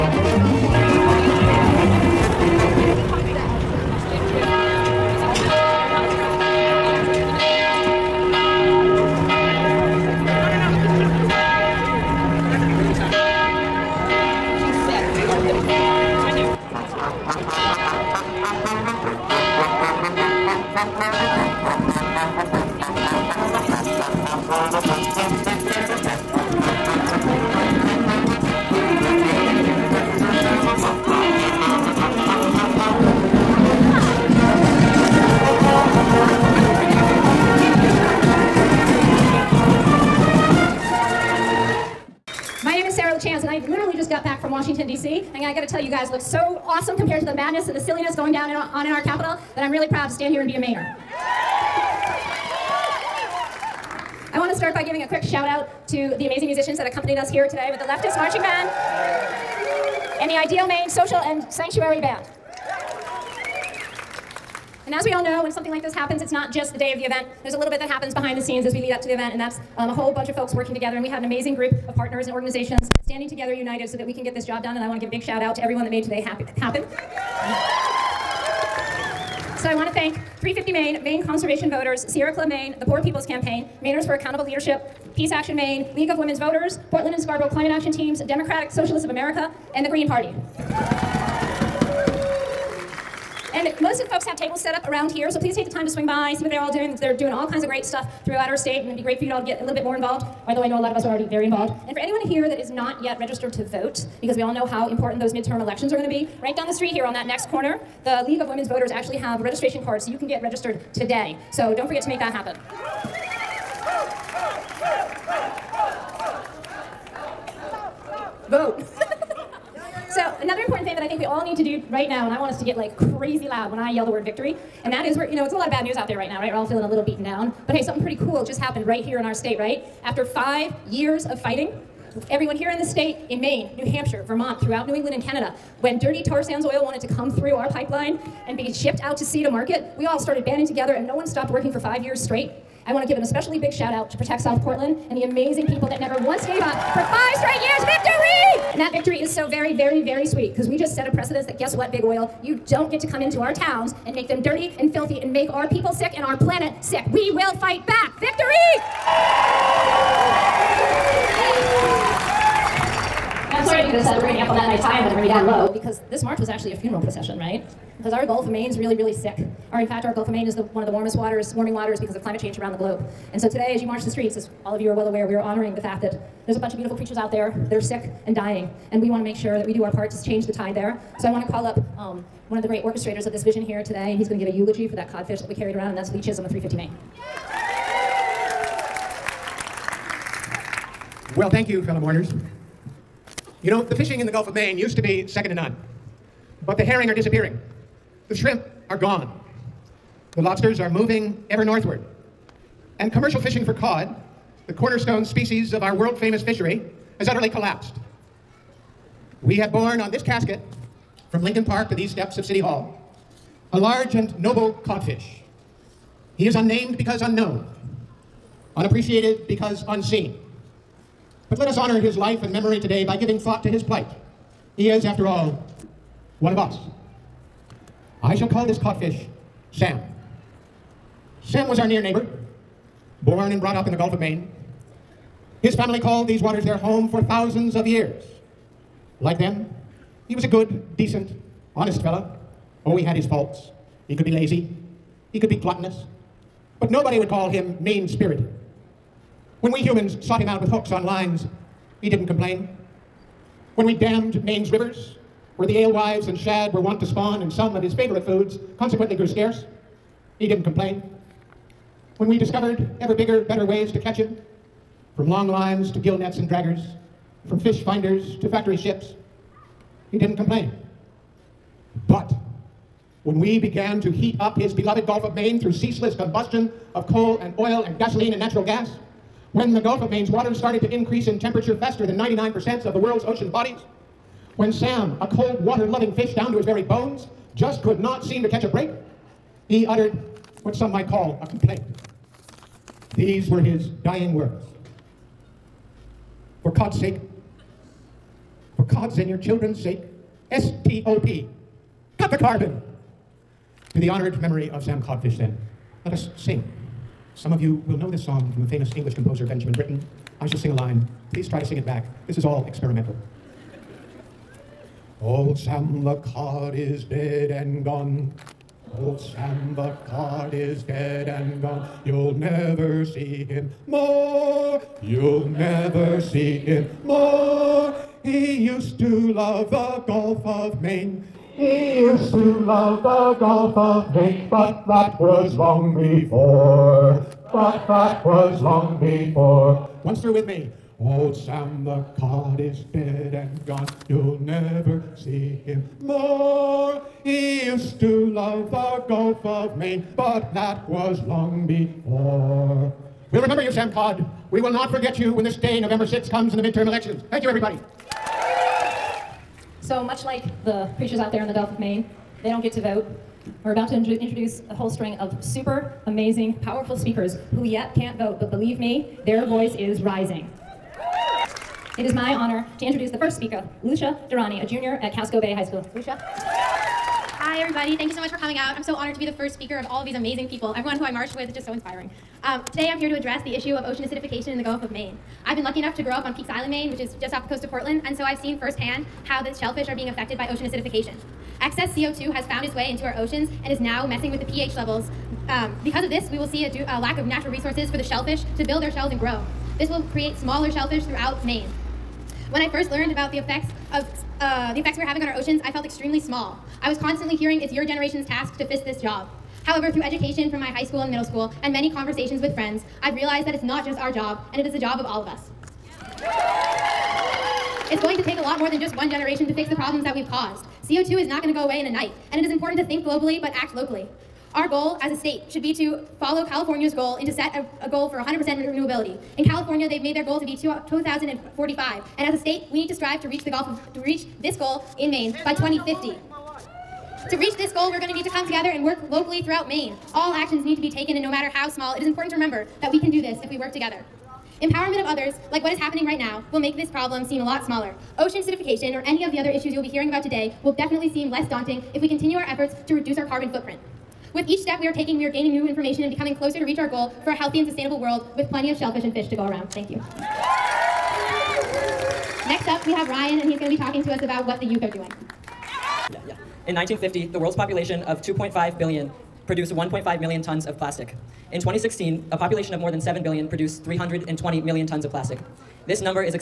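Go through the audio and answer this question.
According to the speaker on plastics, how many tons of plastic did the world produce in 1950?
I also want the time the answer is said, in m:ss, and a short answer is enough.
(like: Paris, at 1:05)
1.5 million tons, at 7:49.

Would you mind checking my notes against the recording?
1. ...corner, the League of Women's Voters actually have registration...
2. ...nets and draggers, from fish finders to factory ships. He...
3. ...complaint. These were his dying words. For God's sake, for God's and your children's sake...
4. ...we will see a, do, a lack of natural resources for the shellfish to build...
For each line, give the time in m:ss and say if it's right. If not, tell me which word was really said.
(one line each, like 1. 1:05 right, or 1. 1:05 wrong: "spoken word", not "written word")
1. 1:47 right
2. 4:26 right
3. 4:51 right
4. 6:36 right.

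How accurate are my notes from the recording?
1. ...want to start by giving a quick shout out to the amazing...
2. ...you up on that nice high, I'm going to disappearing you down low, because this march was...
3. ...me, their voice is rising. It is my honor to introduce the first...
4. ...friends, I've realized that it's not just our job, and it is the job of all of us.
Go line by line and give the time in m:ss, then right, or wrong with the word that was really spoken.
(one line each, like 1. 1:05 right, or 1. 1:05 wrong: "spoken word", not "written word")
1. 0:54 right
2. 2:44 wrong: "bring", not "disappearing"
3. 6:08 right
4. 6:52 right.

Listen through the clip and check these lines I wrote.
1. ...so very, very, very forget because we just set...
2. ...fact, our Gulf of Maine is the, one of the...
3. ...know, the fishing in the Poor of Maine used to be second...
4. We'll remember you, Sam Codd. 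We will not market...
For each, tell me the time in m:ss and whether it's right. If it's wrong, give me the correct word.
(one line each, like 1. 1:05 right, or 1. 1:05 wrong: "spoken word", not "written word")
1. 2:29 wrong: "sweet", not "forget"
2. 2:49 right
3. 3:13 wrong: "Gulf", not "Poor"
4. 5:53 wrong: "forget", not "market".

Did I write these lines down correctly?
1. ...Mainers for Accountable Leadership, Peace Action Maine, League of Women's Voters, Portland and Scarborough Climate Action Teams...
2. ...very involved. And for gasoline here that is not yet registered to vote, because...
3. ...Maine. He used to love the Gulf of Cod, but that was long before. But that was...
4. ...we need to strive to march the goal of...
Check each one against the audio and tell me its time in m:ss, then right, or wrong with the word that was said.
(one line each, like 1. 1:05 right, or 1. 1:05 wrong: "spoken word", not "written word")
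1. 1:23 right
2. 1:41 wrong: "anyone", not "gasoline"
3. 5:30 wrong: "Maine", not "Cod"
4. 7:12 wrong: "reach", not "march".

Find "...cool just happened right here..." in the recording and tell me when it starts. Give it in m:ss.
2:08.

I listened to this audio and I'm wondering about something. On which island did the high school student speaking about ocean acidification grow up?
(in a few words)
Peaks Island.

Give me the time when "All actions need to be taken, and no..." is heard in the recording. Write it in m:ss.
7:20.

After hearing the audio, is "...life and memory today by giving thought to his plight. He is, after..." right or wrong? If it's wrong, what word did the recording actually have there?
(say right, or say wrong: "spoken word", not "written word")
right.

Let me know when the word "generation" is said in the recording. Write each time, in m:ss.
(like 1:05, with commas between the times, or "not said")
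6:47, 6:59.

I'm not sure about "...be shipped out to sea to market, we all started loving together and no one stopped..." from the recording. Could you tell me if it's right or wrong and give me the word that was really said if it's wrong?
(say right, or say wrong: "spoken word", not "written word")
wrong: "banding", not "loving".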